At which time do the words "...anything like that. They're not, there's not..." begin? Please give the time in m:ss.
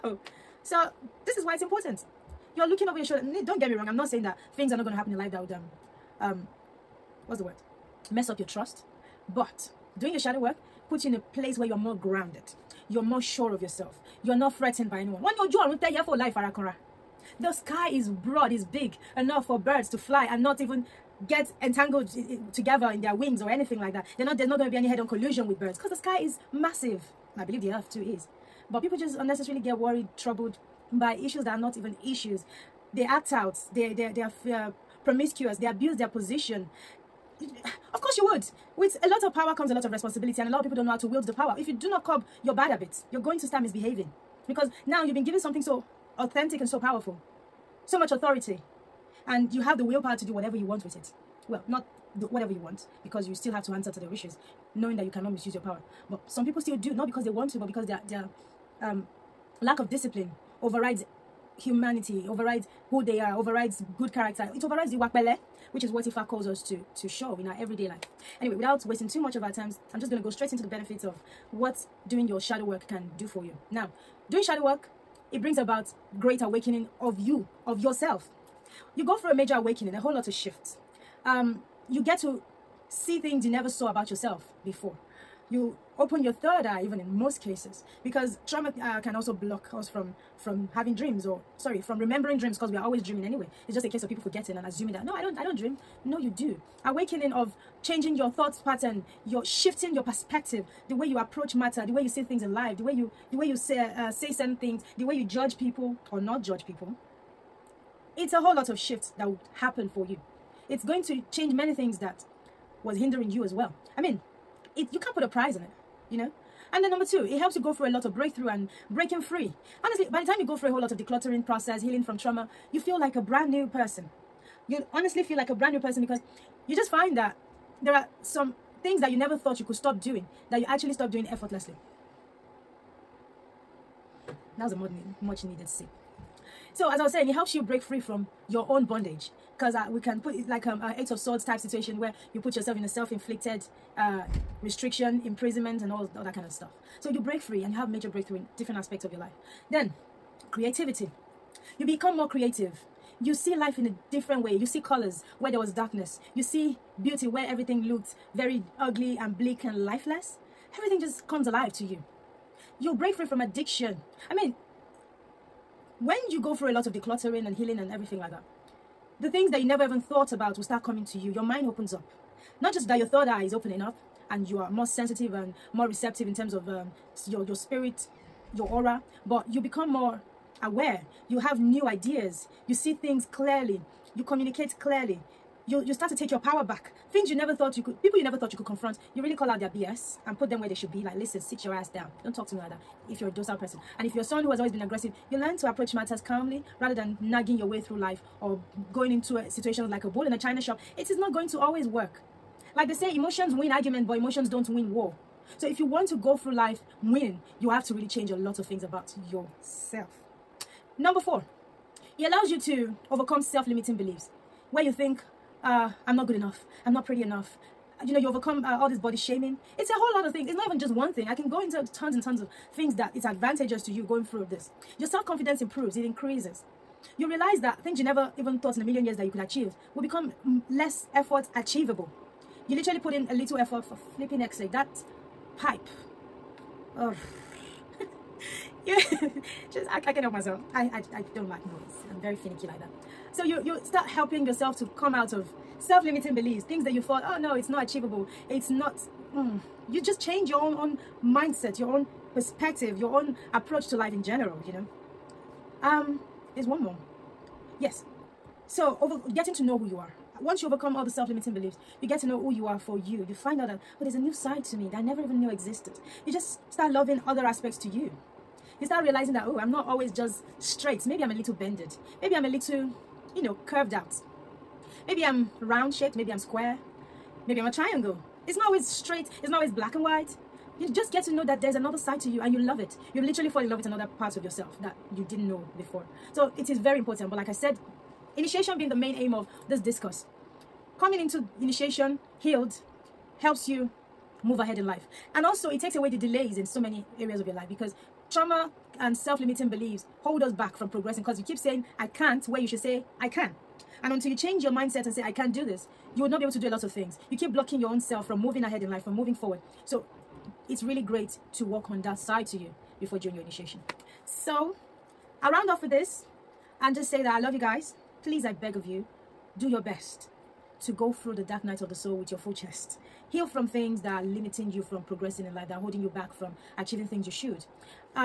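0:23.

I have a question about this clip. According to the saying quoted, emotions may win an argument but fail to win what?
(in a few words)
war.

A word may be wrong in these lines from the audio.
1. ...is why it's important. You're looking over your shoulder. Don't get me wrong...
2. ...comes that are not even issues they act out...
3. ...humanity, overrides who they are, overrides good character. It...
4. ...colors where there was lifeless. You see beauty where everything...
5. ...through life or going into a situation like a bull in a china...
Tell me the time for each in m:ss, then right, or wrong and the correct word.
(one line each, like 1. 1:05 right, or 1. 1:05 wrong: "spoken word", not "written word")
1. 0:01 right
2. 0:31 wrong: "issues", not "comes"
3. 1:01 right
4. 2:34 wrong: "darkness", not "lifeless"
5. 3:17 right.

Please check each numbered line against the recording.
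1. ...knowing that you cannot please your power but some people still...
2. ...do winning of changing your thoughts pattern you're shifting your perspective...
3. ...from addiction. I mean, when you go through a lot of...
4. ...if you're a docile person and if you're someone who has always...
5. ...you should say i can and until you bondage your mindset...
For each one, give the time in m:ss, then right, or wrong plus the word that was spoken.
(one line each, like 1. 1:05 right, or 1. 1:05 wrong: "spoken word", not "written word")
1. 0:54 wrong: "misuse", not "please"
2. 1:36 wrong: "awakening", not "winning"
3. 2:43 right
4. 3:13 right
5. 5:02 wrong: "change", not "bondage".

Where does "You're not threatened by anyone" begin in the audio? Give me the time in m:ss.
0:14.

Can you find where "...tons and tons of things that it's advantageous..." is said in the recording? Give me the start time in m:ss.
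3:41.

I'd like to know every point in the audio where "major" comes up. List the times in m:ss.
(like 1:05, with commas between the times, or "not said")
1:19, 2:27.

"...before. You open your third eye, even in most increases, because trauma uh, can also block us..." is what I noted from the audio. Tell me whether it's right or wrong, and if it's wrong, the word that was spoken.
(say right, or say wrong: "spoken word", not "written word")
wrong: "cases", not "increases".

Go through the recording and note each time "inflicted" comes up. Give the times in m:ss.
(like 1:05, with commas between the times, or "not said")
2:22.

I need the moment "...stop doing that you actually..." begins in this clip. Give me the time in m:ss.
2:09.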